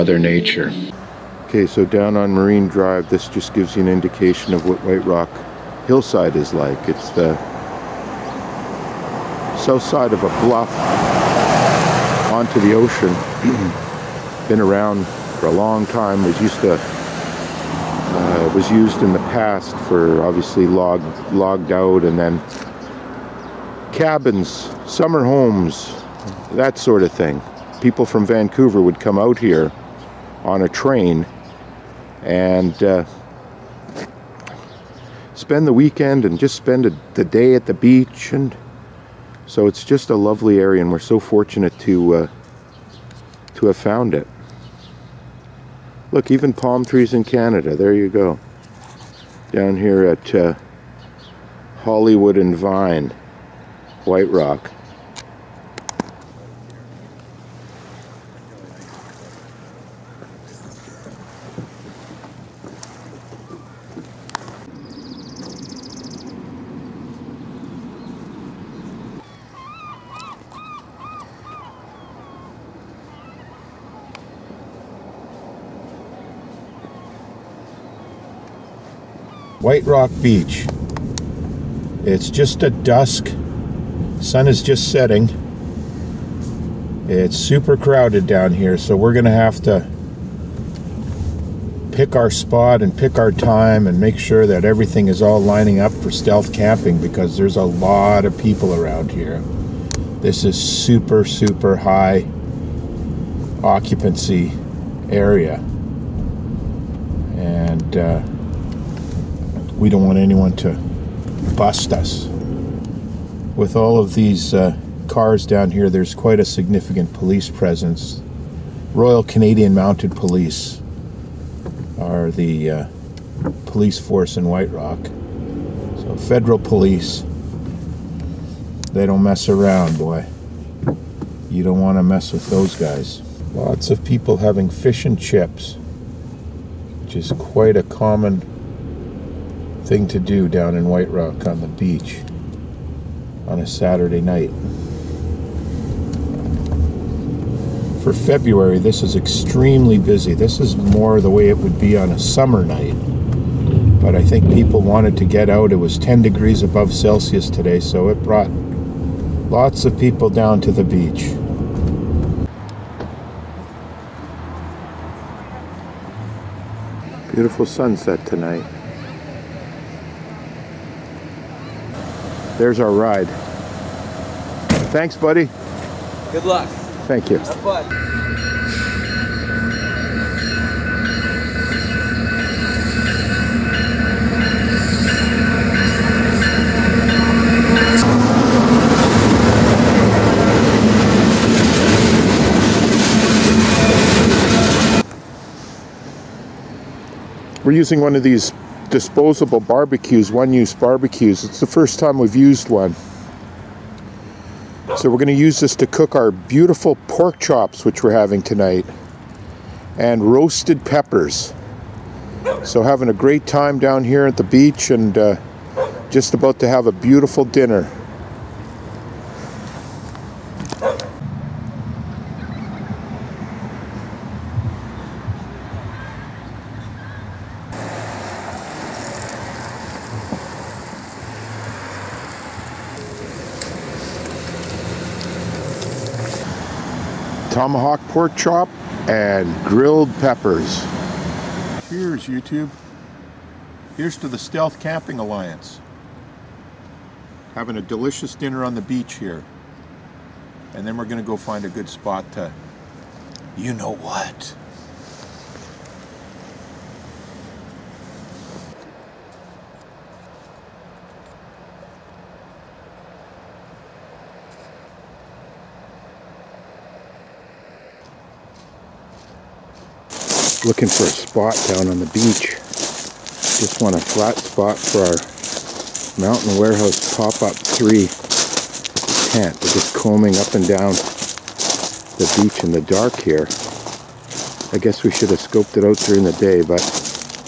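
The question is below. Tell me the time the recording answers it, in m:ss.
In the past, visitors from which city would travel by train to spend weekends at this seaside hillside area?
0:28.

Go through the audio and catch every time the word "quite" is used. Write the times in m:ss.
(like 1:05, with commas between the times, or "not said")
1:56, 2:17.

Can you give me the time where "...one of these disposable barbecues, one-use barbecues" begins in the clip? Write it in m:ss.
3:18.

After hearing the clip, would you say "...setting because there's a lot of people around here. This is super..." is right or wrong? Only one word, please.
wrong.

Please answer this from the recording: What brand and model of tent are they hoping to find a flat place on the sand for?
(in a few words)
Mountain Warehouse Pop-Up 3.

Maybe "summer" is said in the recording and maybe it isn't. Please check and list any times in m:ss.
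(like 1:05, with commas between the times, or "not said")
0:24, 2:32.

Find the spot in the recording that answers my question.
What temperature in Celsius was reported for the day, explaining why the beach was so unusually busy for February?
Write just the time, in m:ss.
2:35.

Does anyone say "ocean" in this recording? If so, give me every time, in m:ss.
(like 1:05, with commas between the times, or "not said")
0:12.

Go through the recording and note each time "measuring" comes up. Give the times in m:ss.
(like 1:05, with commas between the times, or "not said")
not said.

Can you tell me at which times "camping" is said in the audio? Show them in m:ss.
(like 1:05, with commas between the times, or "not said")
1:36, 4:04.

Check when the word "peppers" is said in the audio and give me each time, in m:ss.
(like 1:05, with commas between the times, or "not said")
3:30, 4:00.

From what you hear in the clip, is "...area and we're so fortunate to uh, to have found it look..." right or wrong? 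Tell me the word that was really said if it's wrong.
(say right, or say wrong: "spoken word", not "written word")
right.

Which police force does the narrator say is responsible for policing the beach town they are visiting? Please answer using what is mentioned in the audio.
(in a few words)
Royal Canadian Mounted Police.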